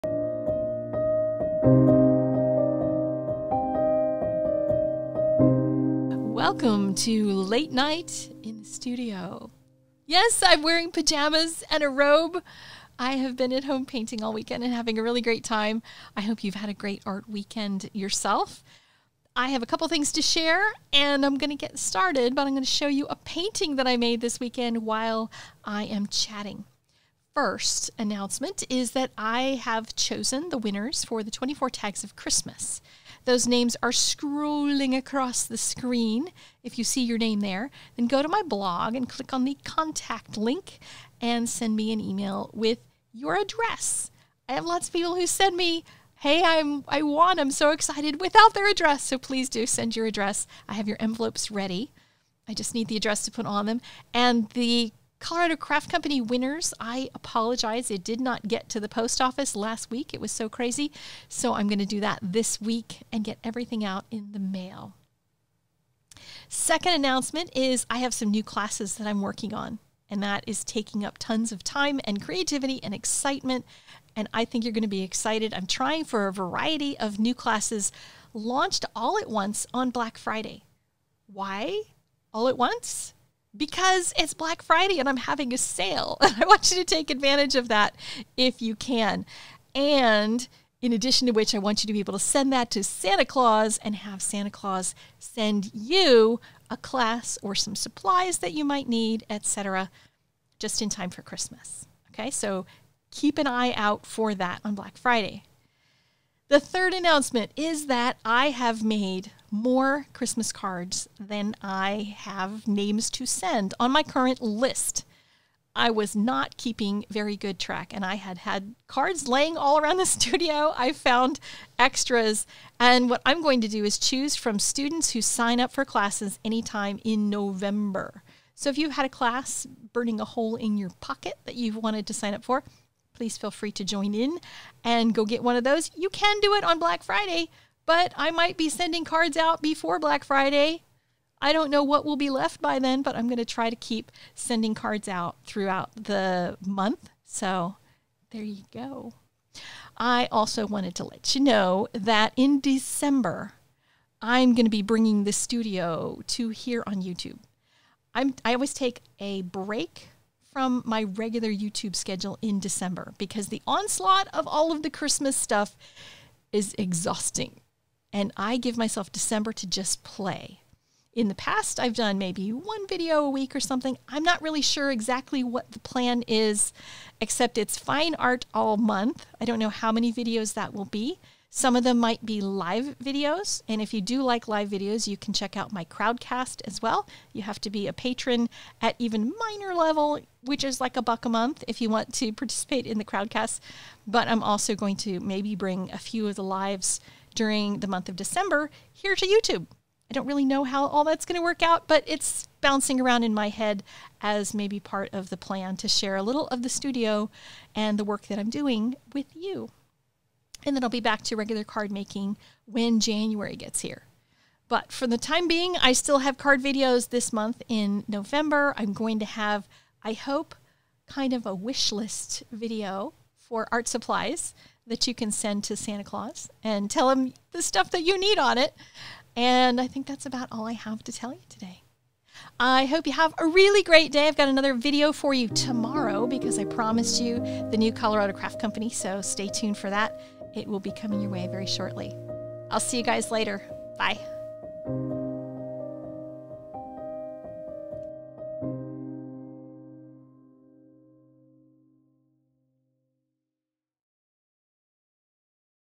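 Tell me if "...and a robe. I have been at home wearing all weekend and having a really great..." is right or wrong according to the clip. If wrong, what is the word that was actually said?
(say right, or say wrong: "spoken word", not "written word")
wrong: "painting", not "wearing".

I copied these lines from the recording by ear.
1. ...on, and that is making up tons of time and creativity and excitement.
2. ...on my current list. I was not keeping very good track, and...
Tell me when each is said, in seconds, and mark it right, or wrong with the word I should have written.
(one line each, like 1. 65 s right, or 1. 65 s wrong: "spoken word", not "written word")
1. 69 s wrong: "taking", not "making"
2. 113 s right.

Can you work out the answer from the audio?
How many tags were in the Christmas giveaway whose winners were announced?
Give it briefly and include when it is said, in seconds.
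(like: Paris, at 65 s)
24, at 31 s.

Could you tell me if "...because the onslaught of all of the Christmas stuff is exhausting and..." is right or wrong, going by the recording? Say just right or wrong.
right.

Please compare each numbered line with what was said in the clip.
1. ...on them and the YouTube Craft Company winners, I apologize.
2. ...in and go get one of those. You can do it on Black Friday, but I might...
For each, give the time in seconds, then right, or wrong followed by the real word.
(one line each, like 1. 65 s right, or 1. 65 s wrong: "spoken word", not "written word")
1. 53 s wrong: "Colorado", not "YouTube"
2. 134 s right.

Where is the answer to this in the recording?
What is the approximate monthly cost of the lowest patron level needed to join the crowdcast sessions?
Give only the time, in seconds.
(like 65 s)
190 s.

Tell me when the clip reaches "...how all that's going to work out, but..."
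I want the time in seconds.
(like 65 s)
200 s.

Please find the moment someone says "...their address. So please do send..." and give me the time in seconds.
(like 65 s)
48 s.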